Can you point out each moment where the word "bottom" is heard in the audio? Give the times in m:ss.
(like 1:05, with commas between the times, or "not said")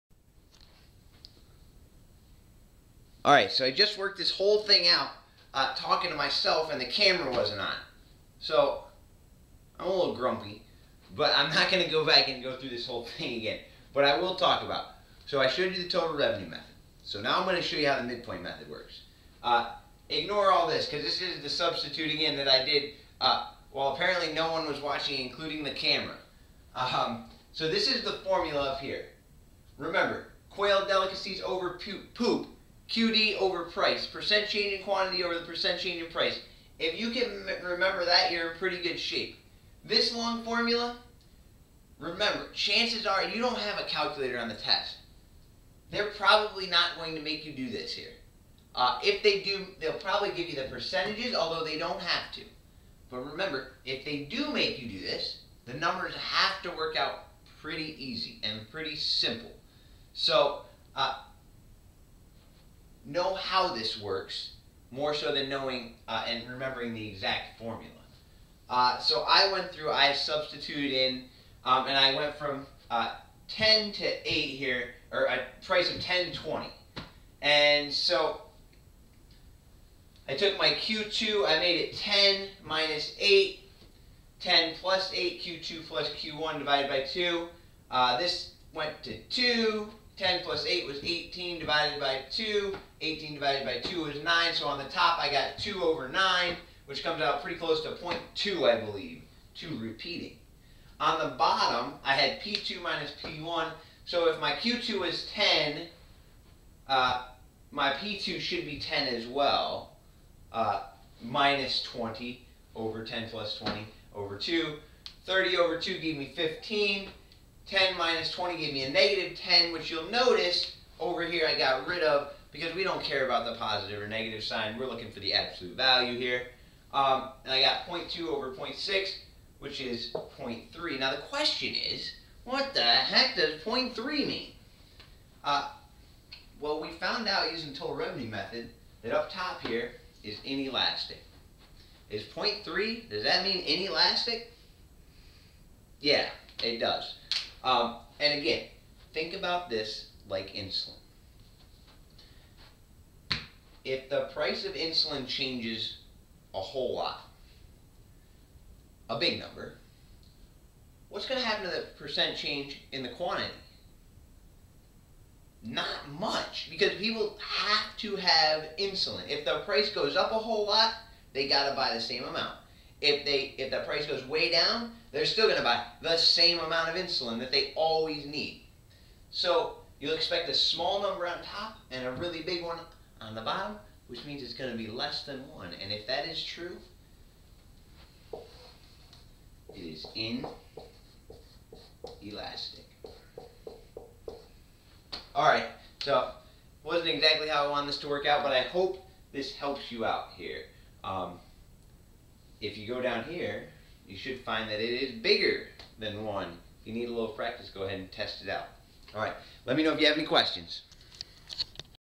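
1:41, 3:03.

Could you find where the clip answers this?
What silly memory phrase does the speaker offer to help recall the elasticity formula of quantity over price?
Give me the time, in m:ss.
0:30.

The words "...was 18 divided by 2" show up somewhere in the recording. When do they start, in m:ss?
1:30.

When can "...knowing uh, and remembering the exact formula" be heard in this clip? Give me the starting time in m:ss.
1:05.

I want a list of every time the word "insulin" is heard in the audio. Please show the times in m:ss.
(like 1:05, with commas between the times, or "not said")
2:30, 2:34, 2:48, 2:56.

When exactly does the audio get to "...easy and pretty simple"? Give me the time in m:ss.
0:58.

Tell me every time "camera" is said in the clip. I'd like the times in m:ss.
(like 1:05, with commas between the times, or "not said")
0:06, 0:25.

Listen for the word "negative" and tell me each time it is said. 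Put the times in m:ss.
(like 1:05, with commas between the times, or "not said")
1:58, 2:04.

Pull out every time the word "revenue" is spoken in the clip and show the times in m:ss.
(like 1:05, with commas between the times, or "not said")
0:16, 2:17.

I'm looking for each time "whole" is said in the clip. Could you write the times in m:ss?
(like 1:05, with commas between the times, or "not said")
0:04, 0:12, 2:36, 2:50.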